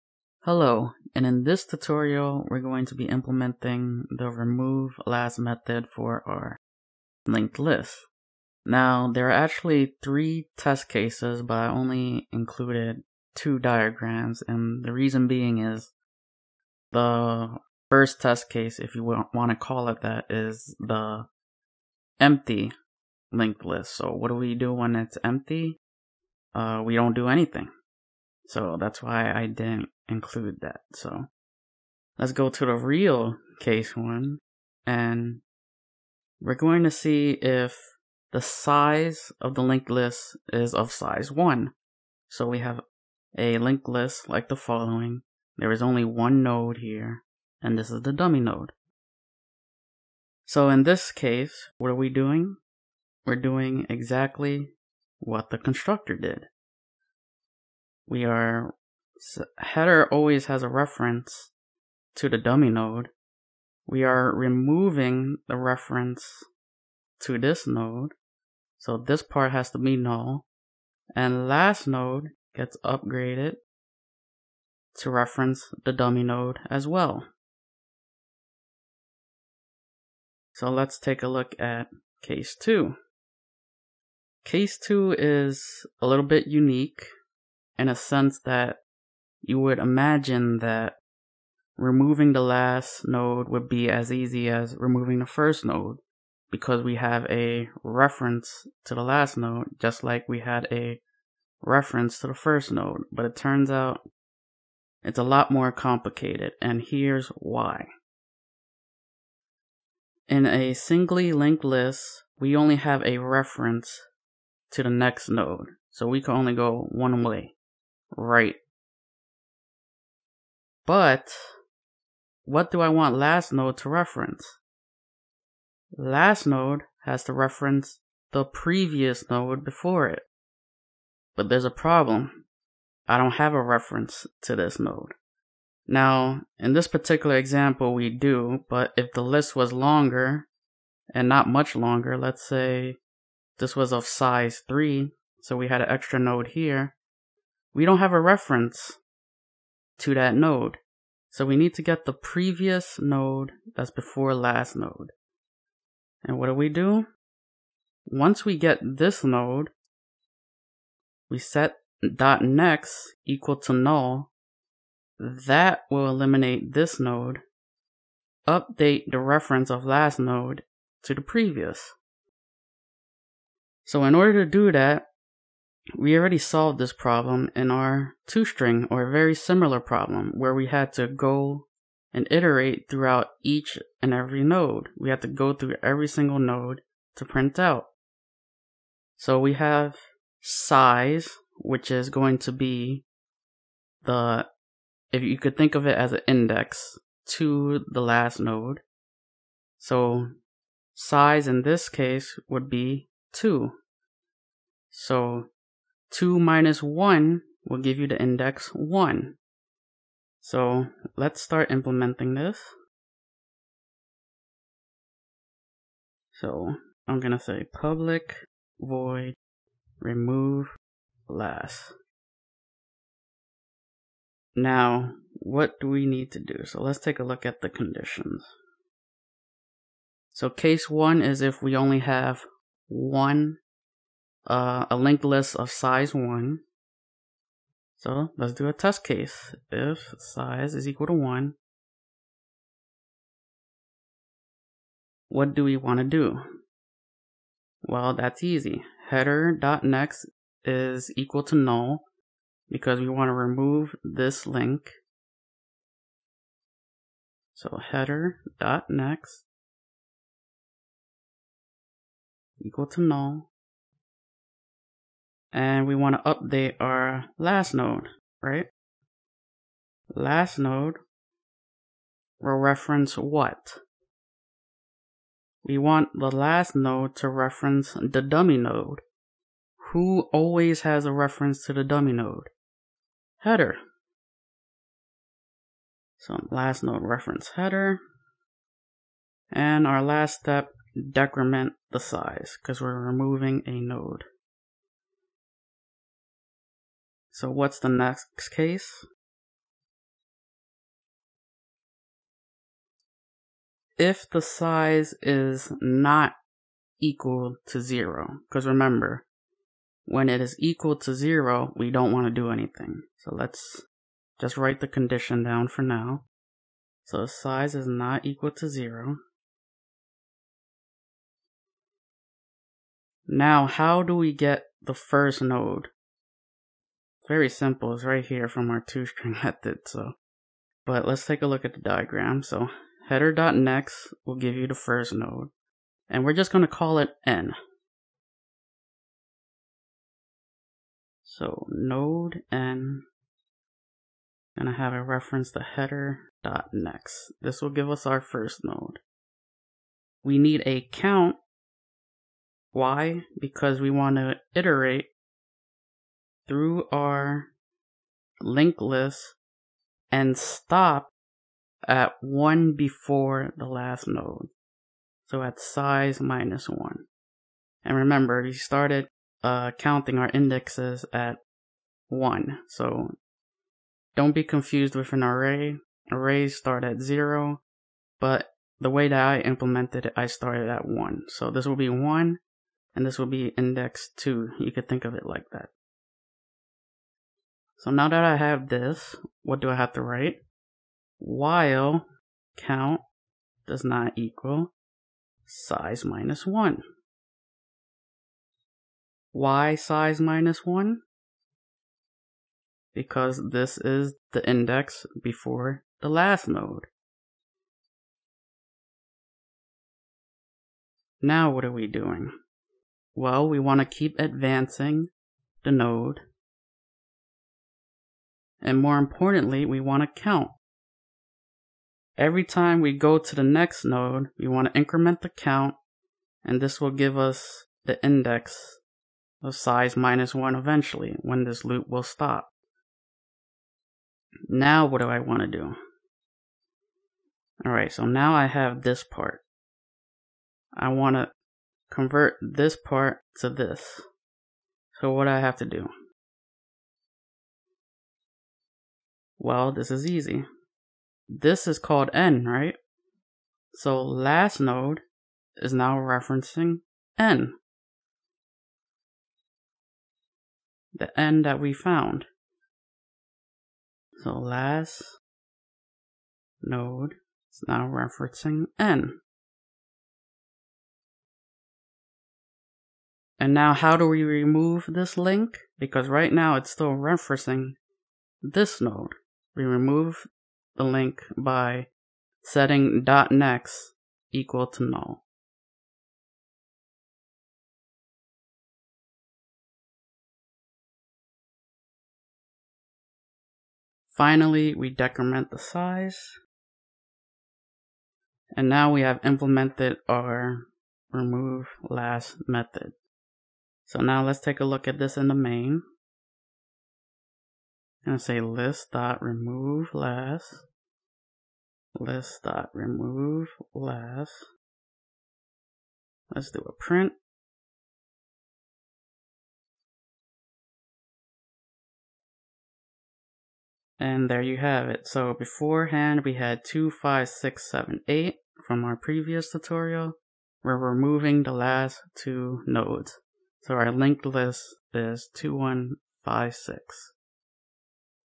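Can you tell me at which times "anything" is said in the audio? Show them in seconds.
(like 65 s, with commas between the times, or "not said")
27 s, 312 s.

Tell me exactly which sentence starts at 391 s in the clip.
While count does not equal size minus 1.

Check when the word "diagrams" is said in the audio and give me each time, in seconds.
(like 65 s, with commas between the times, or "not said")
13 s, 331 s.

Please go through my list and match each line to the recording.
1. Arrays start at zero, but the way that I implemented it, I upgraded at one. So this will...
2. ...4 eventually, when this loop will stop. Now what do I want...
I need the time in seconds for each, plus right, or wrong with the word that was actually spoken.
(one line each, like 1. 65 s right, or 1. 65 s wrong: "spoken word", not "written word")
1. 376 s wrong: "started", not "upgraded"
2. 430 s wrong: "1", not "4".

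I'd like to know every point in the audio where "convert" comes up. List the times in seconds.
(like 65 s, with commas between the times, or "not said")
441 s.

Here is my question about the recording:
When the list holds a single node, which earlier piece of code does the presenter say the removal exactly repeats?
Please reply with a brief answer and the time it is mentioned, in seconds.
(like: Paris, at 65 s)
the constructor, at 55 s.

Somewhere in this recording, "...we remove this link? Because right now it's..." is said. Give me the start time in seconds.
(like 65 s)
474 s.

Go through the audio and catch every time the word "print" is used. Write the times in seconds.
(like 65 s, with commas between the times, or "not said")
187 s, 516 s.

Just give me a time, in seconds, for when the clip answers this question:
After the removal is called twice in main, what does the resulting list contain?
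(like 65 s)
535 s.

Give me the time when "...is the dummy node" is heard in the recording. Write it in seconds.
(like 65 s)
47 s.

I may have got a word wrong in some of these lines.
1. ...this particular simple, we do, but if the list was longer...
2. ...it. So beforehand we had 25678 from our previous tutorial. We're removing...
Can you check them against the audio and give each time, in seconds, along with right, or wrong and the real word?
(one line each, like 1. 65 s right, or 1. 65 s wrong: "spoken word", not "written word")
1. 136 s wrong: "example", not "simple"
2. 524 s right.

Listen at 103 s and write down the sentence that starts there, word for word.
But it turns out it's a lot more complicated, and here's why.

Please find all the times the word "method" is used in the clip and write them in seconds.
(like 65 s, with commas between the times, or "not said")
5 s, 329 s, 502 s.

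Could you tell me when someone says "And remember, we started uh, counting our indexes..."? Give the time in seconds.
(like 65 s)
367 s.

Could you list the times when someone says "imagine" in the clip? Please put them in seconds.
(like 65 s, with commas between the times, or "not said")
89 s.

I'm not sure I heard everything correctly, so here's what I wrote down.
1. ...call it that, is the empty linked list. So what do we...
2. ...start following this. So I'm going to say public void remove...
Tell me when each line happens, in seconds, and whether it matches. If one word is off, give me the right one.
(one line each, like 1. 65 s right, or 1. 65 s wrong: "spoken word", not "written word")
1. 19 s right
2. 211 s wrong: "implementing", not "following".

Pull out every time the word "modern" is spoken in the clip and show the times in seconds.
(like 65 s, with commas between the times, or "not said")
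not said.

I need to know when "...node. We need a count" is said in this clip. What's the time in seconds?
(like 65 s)
348 s.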